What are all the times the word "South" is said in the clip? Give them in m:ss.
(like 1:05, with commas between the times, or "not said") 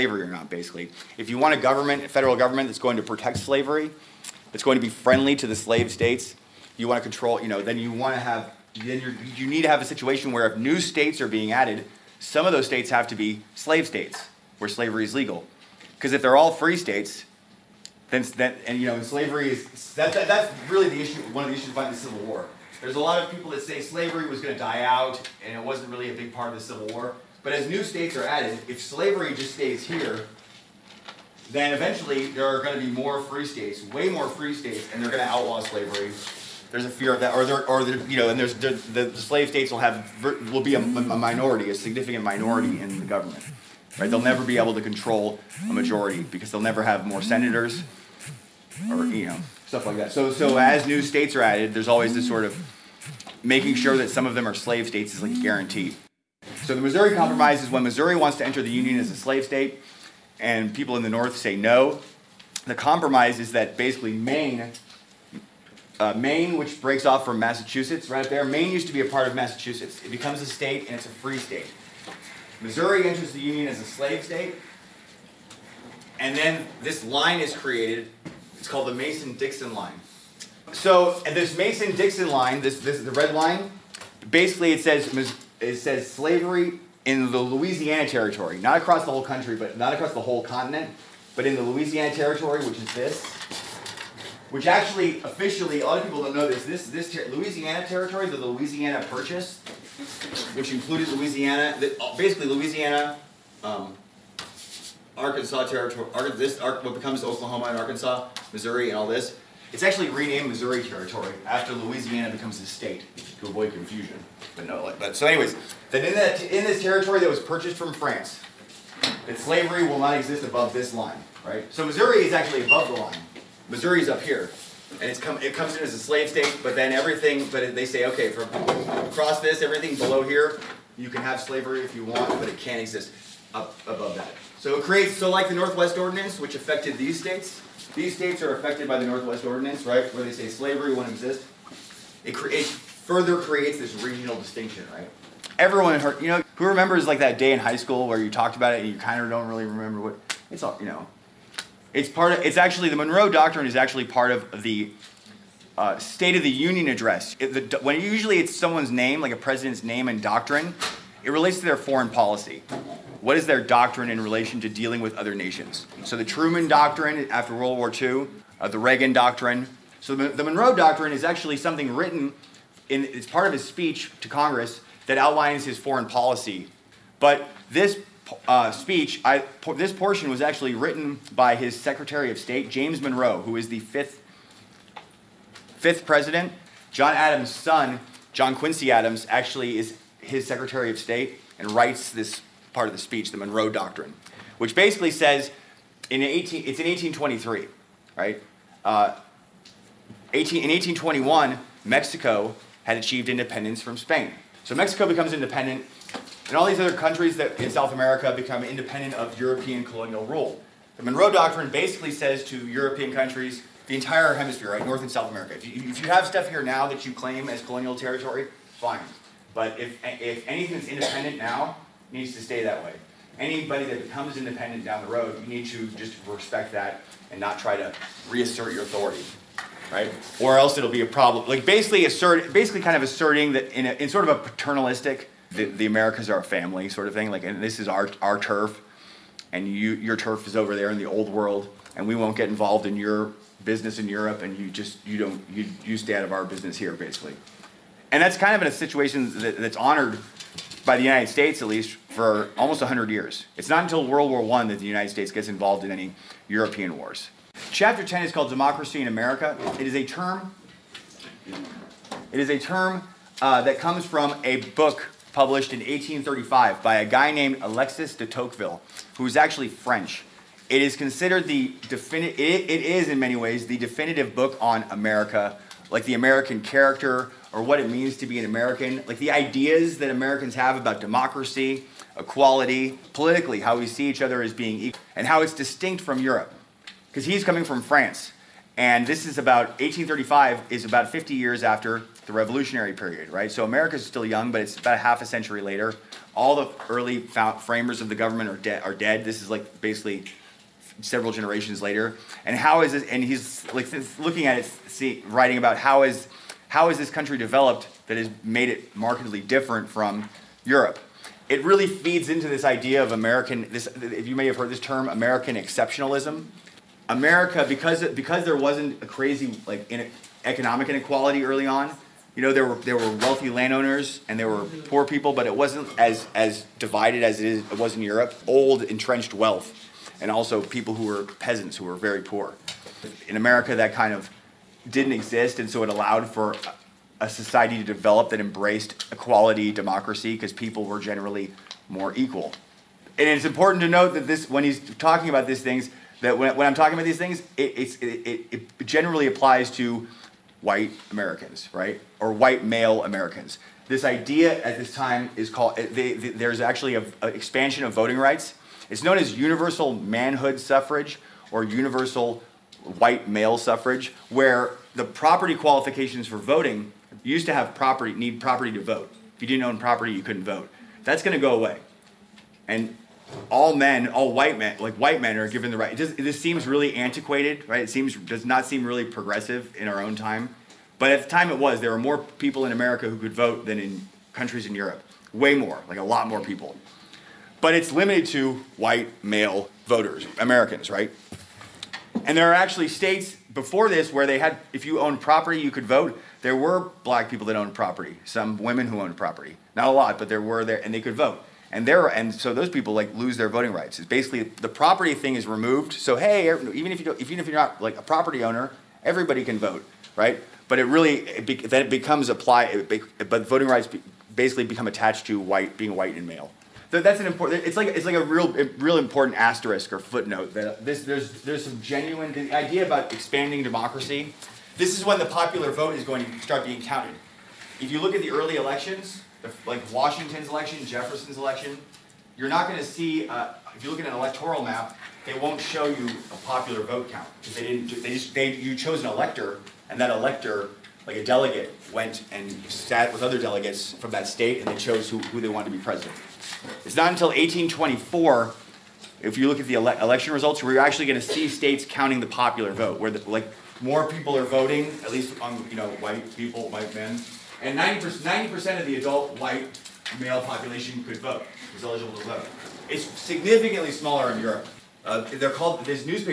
3:27, 3:35.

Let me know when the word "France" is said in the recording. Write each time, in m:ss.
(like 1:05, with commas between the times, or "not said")
1:57, 4:47.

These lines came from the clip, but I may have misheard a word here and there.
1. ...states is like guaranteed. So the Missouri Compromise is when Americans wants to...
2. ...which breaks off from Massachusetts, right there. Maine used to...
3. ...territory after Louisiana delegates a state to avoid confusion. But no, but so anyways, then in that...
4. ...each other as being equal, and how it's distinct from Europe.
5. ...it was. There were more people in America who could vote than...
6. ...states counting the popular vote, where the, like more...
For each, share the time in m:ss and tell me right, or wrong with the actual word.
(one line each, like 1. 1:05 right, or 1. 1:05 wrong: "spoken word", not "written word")
1. 0:54 wrong: "Missouri", not "Americans"
2. 1:06 right
3. 1:50 wrong: "becomes", not "delegates"
4. 4:44 right
5. 6:21 right
6. 7:31 right.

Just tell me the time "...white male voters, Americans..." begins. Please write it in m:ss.
6:28.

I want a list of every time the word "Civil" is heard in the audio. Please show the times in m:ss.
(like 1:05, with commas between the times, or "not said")
0:21, 0:26.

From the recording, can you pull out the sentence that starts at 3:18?
Uh, 18, in 1821, Mexico had achieved independence from Spain.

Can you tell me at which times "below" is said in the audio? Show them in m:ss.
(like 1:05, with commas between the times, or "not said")
2:09.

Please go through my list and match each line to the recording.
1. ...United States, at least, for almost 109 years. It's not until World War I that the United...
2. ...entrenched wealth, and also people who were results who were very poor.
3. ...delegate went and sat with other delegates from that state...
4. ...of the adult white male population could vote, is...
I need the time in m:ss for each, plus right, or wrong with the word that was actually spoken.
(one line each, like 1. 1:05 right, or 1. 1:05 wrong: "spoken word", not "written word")
1. 4:11 wrong: "100", not "109"
2. 5:28 wrong: "peasants", not "results"
3. 7:21 right
4. 7:38 right.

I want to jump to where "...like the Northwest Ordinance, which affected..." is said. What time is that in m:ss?
2:15.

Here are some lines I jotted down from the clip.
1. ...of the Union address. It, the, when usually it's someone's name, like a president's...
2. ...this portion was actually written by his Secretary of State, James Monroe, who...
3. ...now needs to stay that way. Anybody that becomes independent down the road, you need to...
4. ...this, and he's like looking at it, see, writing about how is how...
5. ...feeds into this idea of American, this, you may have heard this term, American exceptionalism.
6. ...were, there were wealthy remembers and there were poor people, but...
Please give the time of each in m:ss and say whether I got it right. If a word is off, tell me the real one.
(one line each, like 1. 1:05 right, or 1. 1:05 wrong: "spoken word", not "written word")
1. 2:36 right
2. 2:59 right
3. 3:41 right
4. 5:02 right
5. 5:11 right
6. 5:22 wrong: "landowners", not "remembers".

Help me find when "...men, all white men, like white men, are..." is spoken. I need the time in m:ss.
6:13.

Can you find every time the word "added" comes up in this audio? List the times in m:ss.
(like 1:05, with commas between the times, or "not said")
0:11, 0:28, 0:51.